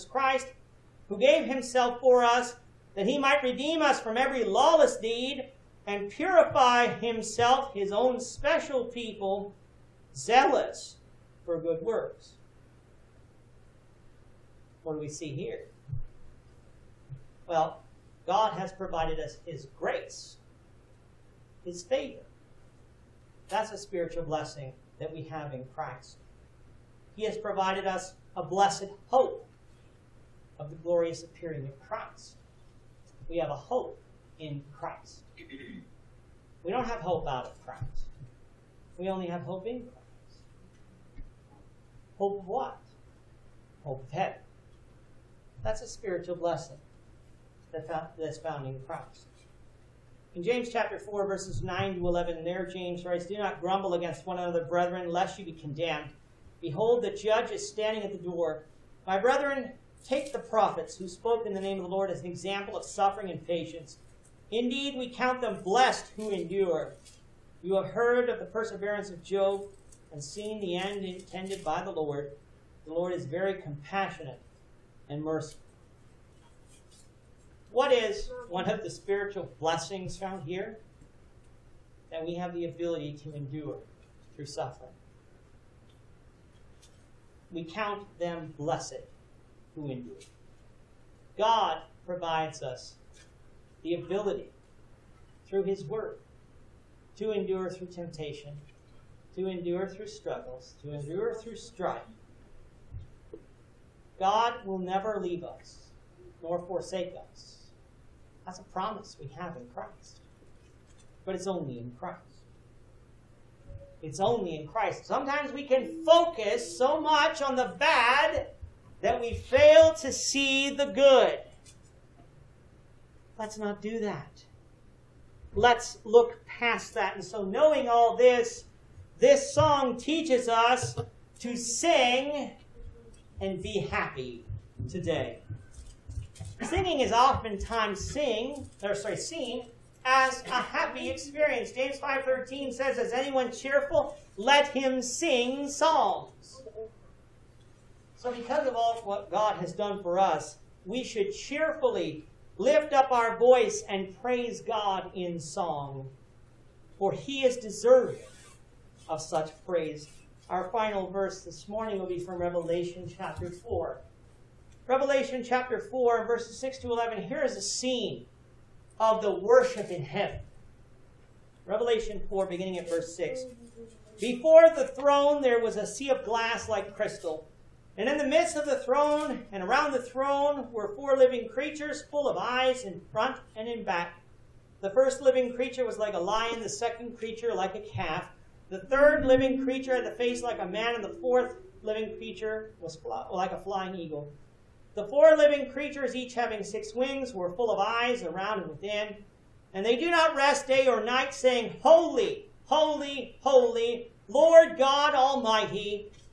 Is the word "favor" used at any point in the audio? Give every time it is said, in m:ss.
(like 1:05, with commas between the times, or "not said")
0:21.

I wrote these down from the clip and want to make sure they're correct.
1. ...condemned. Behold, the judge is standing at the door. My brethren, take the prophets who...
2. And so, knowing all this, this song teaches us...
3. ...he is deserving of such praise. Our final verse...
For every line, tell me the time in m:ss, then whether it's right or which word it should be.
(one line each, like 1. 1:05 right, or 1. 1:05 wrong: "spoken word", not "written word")
1. 0:55 right
2. 2:07 right
3. 2:37 right.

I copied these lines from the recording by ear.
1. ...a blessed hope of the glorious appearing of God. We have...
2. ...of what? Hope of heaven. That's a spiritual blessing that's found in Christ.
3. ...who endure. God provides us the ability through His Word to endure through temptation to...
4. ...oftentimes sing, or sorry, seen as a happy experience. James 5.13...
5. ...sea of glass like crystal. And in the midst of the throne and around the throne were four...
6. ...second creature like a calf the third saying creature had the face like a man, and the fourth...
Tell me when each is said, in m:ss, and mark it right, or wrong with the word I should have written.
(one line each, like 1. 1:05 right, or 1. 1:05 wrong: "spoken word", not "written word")
1. 0:28 wrong: "Christ", not "God"
2. 0:42 right
3. 1:29 right
4. 2:17 right
5. 2:55 right
6. 3:06 wrong: "living", not "saying".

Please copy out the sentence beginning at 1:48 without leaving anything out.
That's a promise we have in Christ.